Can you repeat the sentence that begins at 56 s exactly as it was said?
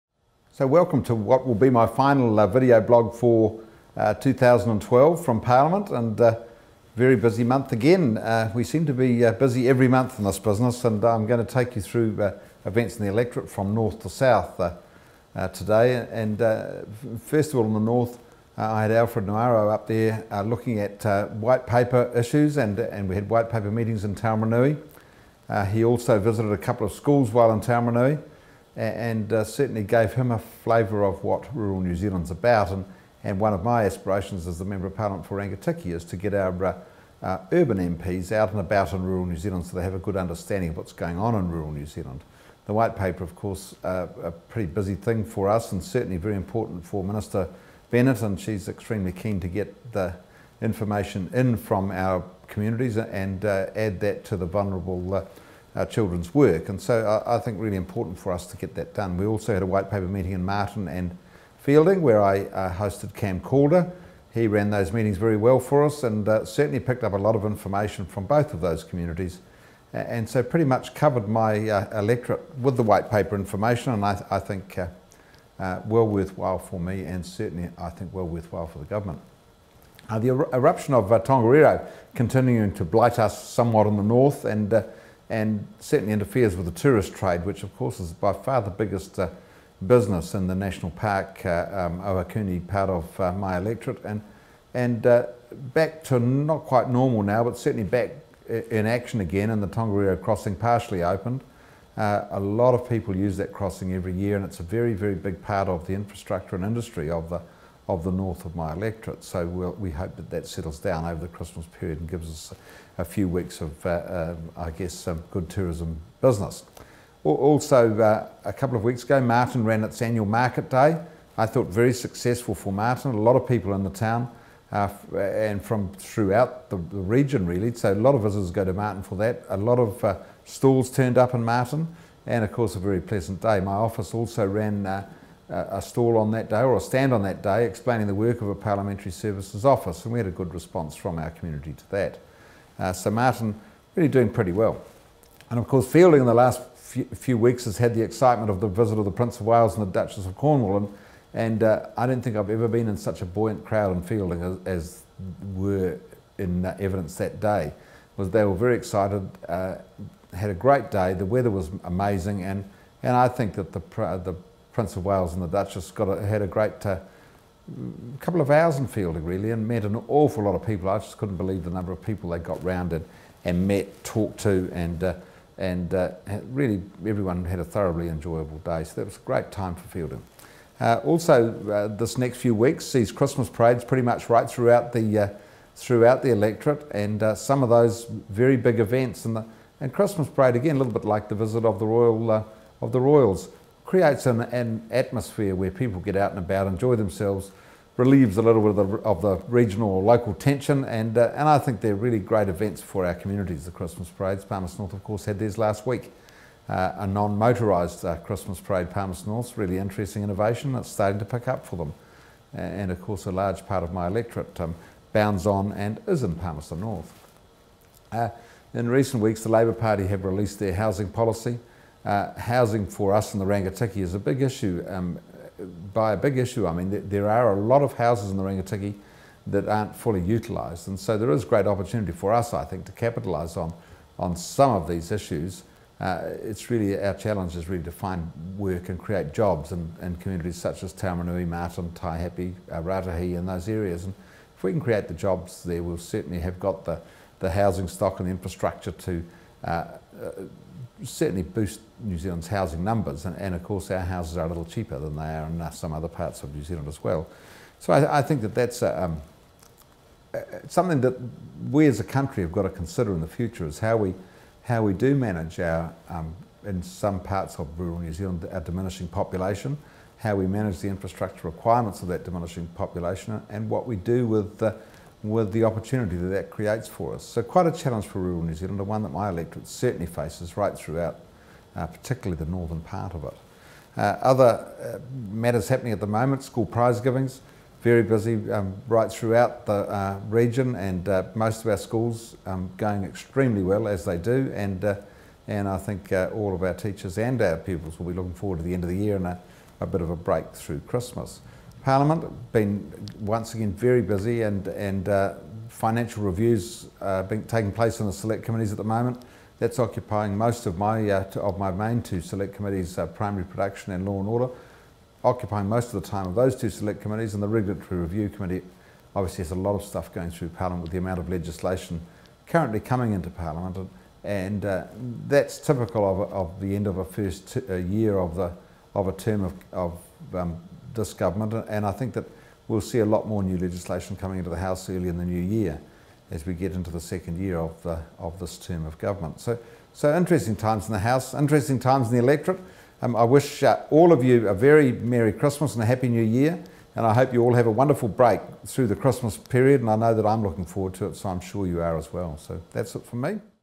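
And so I, I, think really important for us to get that done.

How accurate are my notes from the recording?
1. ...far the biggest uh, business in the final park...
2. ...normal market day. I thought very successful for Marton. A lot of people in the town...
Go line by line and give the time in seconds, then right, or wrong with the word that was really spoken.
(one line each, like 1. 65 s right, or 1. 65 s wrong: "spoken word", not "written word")
1. 88 s wrong: "national", not "final"
2. 120 s wrong: "annual", not "normal".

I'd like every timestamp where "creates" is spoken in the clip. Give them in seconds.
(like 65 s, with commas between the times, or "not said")
193 s, 238 s, 244 s, 276 s.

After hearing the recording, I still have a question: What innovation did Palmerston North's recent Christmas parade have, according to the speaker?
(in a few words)
Non-motorised.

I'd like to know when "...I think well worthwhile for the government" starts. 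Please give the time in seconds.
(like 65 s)
77 s.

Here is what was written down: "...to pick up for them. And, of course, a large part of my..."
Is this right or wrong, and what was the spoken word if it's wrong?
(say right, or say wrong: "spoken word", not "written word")
right.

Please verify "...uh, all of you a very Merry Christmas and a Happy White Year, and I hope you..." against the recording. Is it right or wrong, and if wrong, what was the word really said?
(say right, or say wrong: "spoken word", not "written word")
wrong: "New", not "White".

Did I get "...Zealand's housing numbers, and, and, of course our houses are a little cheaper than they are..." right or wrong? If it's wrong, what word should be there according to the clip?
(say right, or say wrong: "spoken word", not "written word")
right.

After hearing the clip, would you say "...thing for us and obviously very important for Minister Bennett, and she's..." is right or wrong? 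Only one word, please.
wrong.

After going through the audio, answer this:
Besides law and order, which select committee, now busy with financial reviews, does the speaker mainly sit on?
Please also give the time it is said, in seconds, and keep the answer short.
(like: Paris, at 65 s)
Primary production, at 313 s.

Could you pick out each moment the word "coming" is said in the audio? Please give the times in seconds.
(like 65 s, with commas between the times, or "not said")
322 s, 334 s.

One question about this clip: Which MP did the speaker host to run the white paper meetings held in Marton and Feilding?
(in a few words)
Cam Calder.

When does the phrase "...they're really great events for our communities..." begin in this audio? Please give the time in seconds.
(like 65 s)
201 s.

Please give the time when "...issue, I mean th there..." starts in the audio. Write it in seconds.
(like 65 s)
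226 s.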